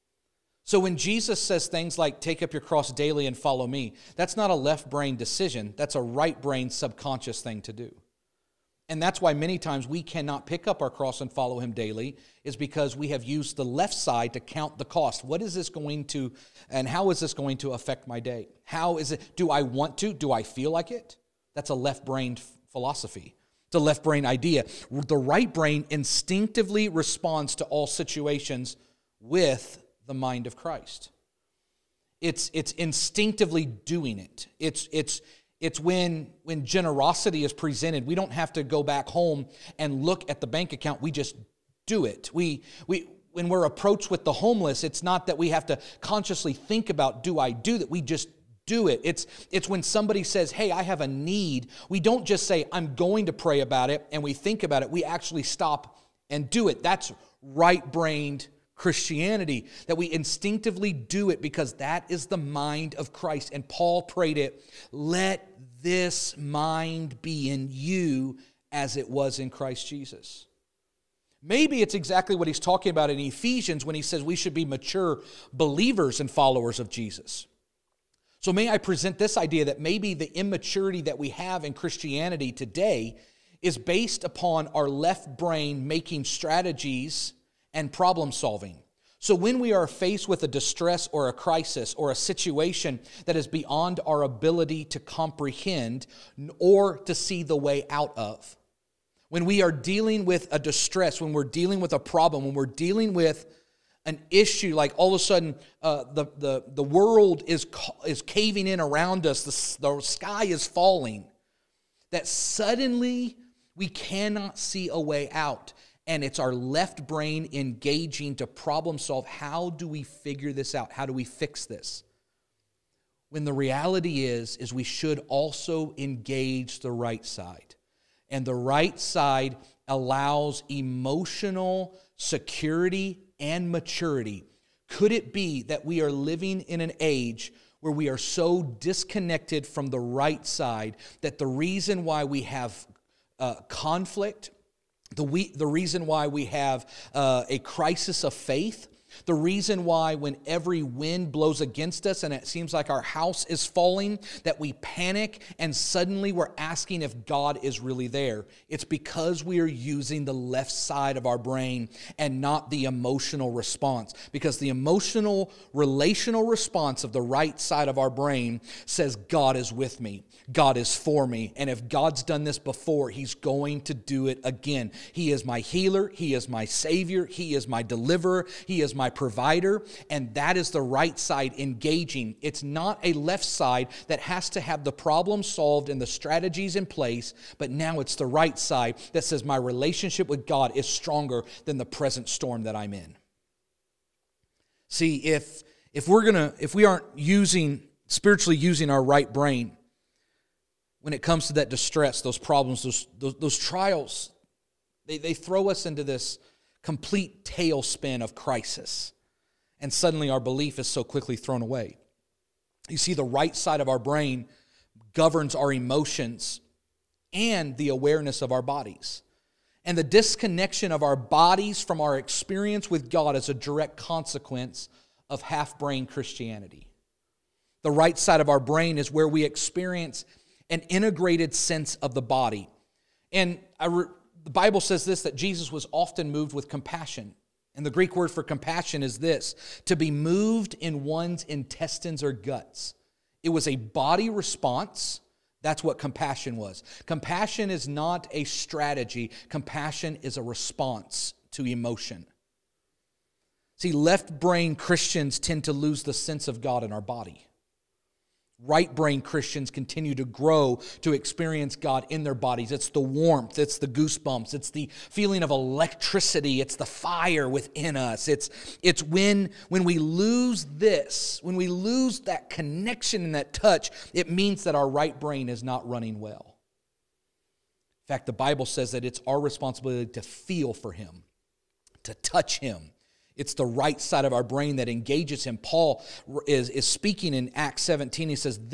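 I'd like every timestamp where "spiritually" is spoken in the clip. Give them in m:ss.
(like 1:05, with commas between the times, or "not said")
3:18.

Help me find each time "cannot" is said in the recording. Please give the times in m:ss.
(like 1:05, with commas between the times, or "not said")
0:10, 1:53.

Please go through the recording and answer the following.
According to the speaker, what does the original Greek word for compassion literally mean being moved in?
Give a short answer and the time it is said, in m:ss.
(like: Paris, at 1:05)
Intestines or guts, at 4:01.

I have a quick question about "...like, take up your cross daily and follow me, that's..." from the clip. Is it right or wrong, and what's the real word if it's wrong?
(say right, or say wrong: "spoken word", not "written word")
right.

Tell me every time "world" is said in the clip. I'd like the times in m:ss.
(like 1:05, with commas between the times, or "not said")
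1:46.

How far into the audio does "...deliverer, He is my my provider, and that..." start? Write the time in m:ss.
2:57.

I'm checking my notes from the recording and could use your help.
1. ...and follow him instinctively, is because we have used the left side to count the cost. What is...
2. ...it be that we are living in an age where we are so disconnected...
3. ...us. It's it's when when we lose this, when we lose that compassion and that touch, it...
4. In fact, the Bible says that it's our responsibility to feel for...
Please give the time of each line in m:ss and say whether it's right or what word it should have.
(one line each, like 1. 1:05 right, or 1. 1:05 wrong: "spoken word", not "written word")
1. 0:11 wrong: "daily", not "instinctively"
2. 2:15 right
3. 4:27 wrong: "connection", not "compassion"
4. 4:38 right.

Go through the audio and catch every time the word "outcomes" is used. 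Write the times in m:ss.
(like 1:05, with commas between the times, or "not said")
not said.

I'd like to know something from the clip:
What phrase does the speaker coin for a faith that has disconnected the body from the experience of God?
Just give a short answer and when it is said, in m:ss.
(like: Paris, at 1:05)
Half brain Christianity, at 3:45.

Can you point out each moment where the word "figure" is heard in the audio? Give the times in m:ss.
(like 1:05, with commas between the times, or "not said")
2:00.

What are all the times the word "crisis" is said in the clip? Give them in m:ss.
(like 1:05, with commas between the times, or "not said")
1:31, 2:27, 3:28.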